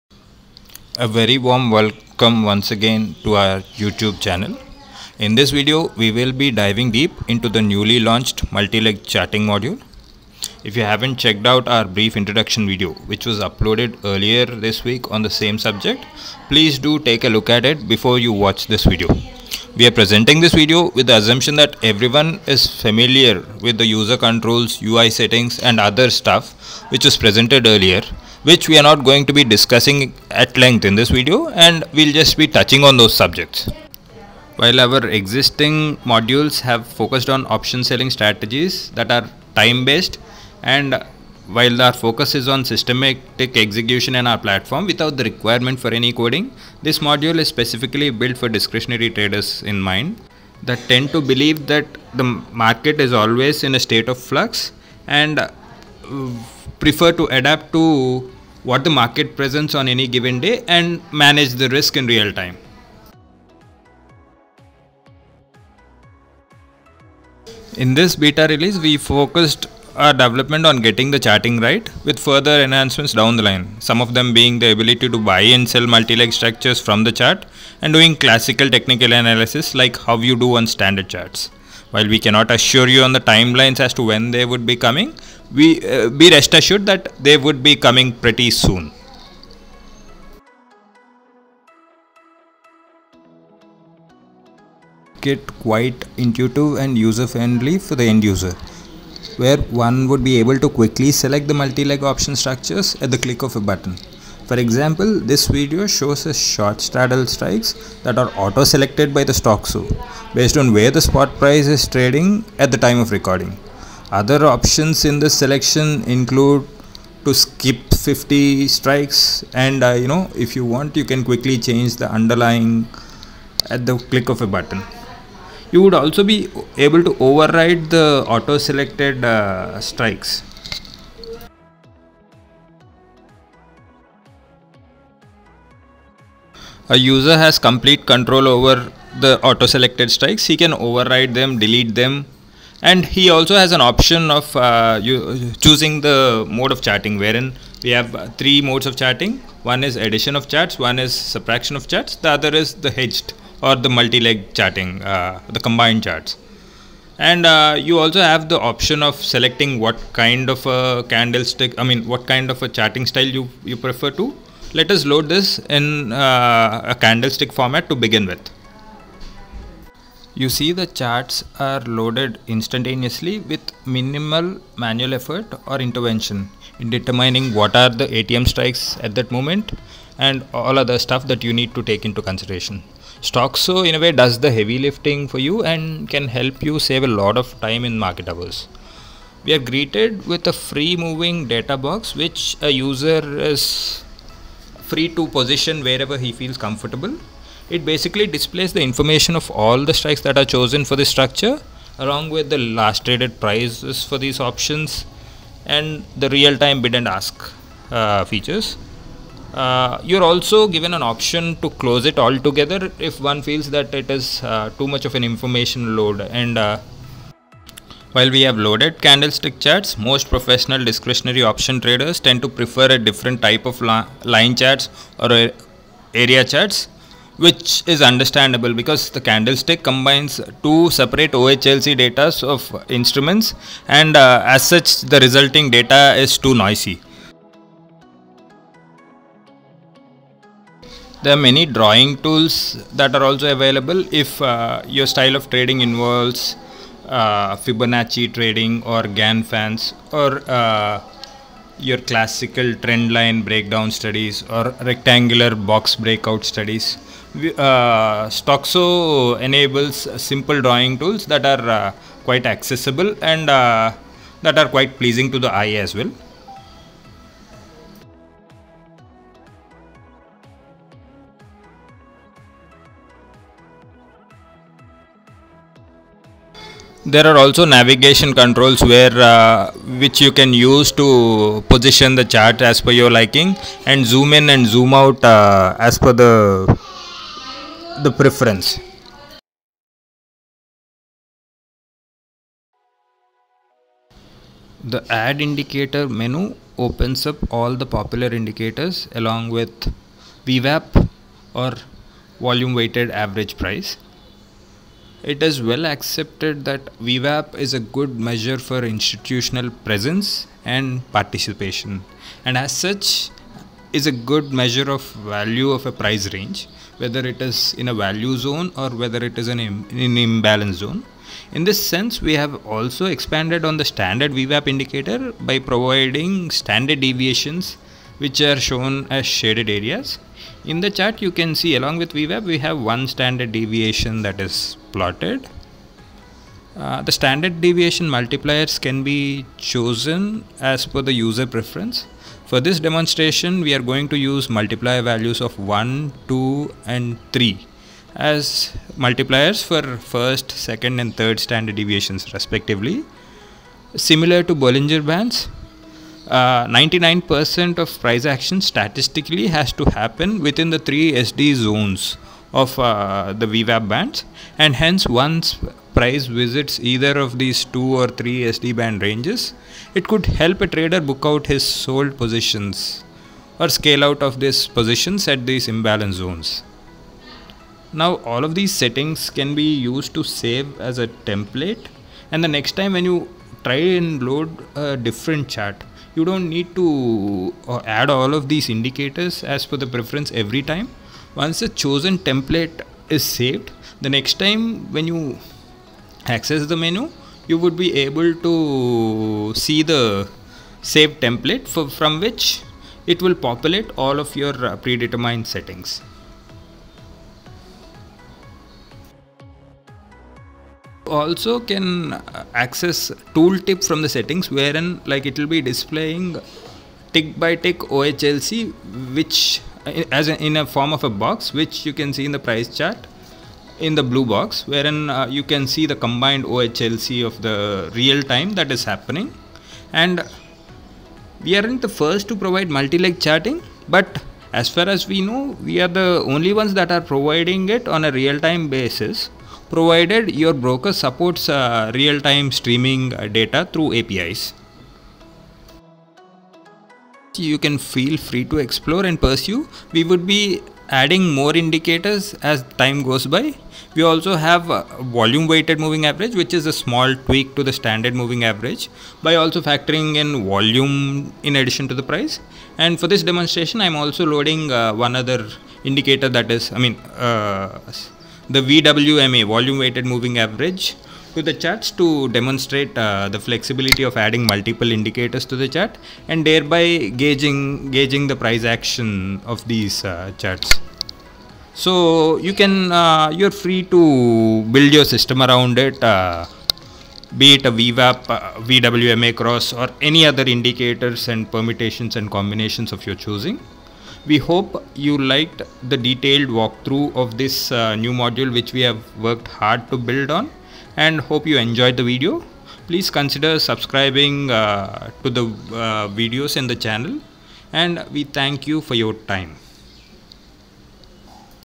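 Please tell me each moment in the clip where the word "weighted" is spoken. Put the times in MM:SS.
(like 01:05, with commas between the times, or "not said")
05:02, 07:35, 07:49.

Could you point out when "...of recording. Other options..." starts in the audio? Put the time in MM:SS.
01:52.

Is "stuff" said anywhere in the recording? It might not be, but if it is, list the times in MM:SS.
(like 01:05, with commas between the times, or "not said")
00:26, 03:00.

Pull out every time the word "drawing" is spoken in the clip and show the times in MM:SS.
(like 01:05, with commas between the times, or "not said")
04:01, 04:20.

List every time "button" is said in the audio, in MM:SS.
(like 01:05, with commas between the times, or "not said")
01:43, 02:04.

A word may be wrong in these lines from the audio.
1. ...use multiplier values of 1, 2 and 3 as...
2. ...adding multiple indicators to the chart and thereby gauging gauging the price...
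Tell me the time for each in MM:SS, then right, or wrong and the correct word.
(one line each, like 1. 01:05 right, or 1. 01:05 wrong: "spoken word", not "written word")
1. 05:44 right
2. 07:54 right.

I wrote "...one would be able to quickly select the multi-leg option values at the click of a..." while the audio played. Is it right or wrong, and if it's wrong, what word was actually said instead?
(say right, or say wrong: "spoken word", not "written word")
wrong: "structures", not "values".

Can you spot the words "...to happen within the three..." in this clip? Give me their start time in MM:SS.
05:59.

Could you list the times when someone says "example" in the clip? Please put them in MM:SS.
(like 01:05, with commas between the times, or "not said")
01:44.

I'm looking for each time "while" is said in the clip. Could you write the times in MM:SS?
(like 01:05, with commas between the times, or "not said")
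00:34, 00:41, 01:21, 03:38.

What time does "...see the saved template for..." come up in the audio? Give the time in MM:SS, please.
06:39.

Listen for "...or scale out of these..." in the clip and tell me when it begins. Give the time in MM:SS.
06:13.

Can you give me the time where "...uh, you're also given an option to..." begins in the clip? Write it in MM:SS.
03:29.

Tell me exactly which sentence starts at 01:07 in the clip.
In this beta release, we focused our development on getting the charting right with further enhancements down the line.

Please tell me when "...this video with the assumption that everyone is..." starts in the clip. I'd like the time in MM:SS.
00:20.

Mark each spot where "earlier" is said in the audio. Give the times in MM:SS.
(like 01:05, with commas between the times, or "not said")
00:14, 00:27.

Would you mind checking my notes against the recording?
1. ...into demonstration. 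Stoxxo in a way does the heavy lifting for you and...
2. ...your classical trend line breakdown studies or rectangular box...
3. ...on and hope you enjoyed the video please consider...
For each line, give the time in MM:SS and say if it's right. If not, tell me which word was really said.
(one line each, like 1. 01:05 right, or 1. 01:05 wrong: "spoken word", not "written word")
1. 03:02 wrong: "consideration", not "demonstration"
2. 04:11 right
3. 08:20 right.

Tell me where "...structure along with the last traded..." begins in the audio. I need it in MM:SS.
03:21.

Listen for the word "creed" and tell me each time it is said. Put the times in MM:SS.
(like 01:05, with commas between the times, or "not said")
not said.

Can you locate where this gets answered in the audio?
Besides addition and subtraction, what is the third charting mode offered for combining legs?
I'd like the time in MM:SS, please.
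02:32.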